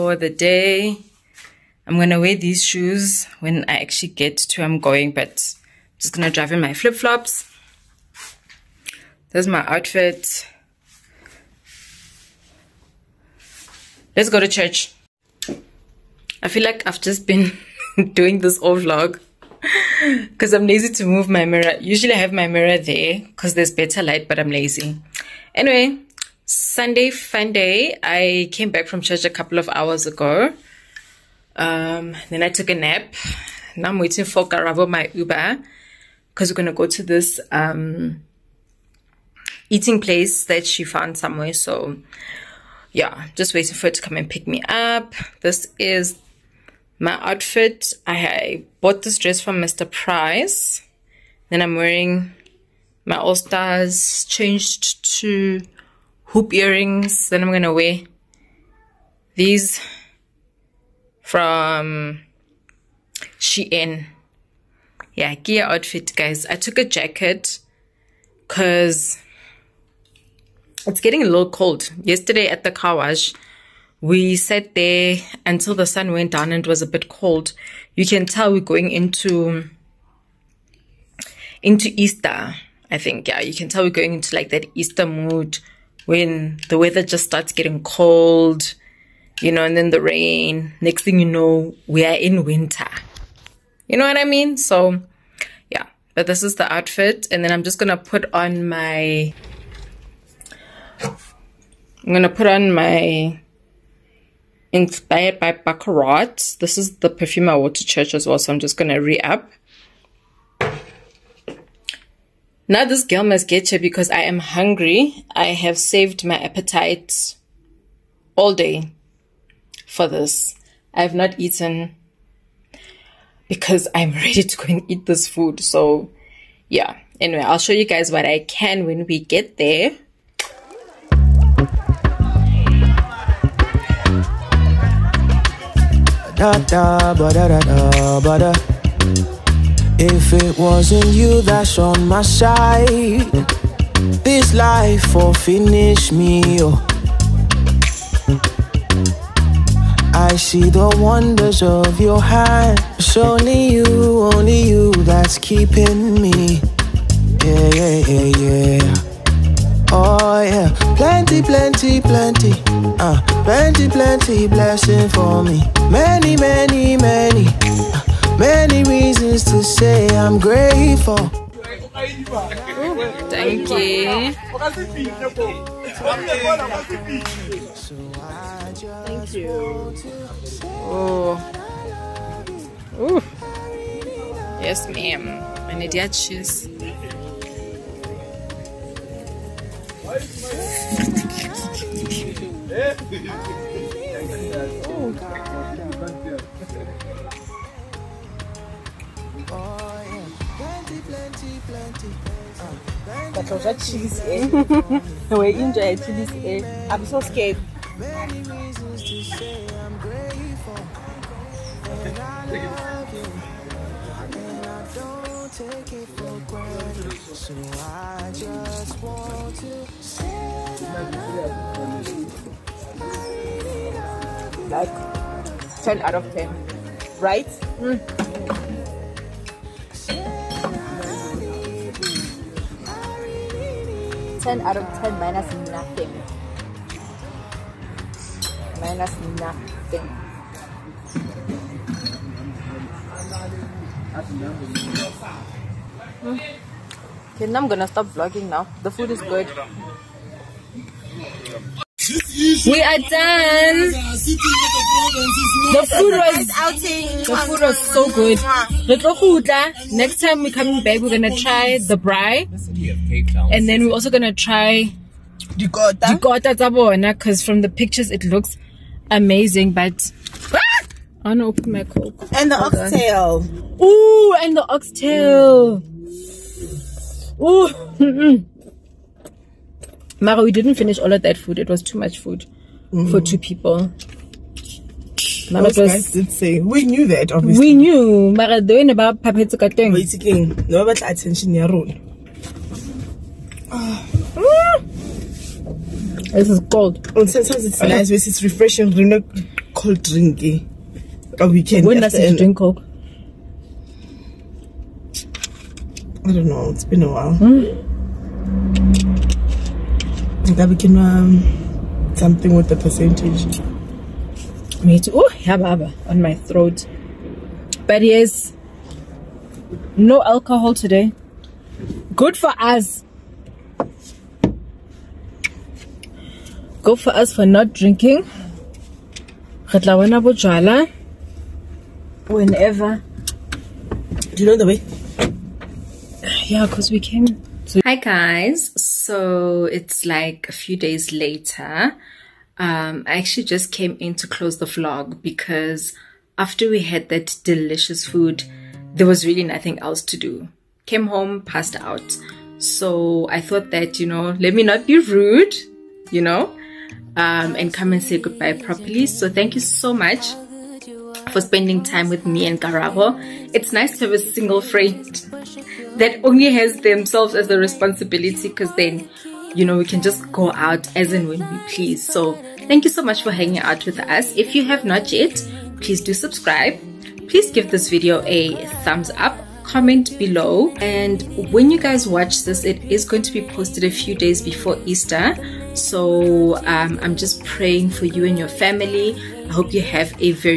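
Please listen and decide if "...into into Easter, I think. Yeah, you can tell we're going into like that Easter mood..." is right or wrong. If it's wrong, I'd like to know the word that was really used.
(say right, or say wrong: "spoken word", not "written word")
right.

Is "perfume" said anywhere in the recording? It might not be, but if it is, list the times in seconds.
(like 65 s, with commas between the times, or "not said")
107 s.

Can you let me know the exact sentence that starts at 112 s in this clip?
Now this girl must get because I am hungry.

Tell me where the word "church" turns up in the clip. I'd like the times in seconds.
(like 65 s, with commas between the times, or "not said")
14 s, 29 s, 107 s.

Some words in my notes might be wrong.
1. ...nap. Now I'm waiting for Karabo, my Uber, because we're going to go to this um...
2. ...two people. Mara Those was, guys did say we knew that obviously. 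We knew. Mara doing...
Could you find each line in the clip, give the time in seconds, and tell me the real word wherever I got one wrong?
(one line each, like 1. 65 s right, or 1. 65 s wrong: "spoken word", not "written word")
1. 32 s right
2. 283 s right.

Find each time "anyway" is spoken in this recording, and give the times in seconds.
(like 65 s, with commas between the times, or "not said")
25 s, 127 s.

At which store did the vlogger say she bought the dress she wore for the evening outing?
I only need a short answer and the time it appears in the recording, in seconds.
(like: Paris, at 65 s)
Mr. Price, at 49 s.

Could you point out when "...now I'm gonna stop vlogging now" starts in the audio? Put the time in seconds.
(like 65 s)
247 s.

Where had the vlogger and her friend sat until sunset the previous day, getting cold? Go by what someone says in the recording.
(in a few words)
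The car wash.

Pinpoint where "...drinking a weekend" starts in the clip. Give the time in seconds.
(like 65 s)
300 s.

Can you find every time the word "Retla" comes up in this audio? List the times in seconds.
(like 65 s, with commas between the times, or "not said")
329 s.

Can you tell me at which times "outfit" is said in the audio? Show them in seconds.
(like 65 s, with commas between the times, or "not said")
9 s, 47 s, 65 s, 96 s.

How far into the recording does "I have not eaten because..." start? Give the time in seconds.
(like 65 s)
120 s.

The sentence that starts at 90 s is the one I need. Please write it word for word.
Next thing you know, we are in winter.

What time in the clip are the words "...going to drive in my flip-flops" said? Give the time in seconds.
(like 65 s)
6 s.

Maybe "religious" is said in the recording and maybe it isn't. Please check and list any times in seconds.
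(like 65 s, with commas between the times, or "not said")
not said.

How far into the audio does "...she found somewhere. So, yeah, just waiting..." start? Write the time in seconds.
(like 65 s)
40 s.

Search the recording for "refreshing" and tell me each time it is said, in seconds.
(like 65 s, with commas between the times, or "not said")
298 s.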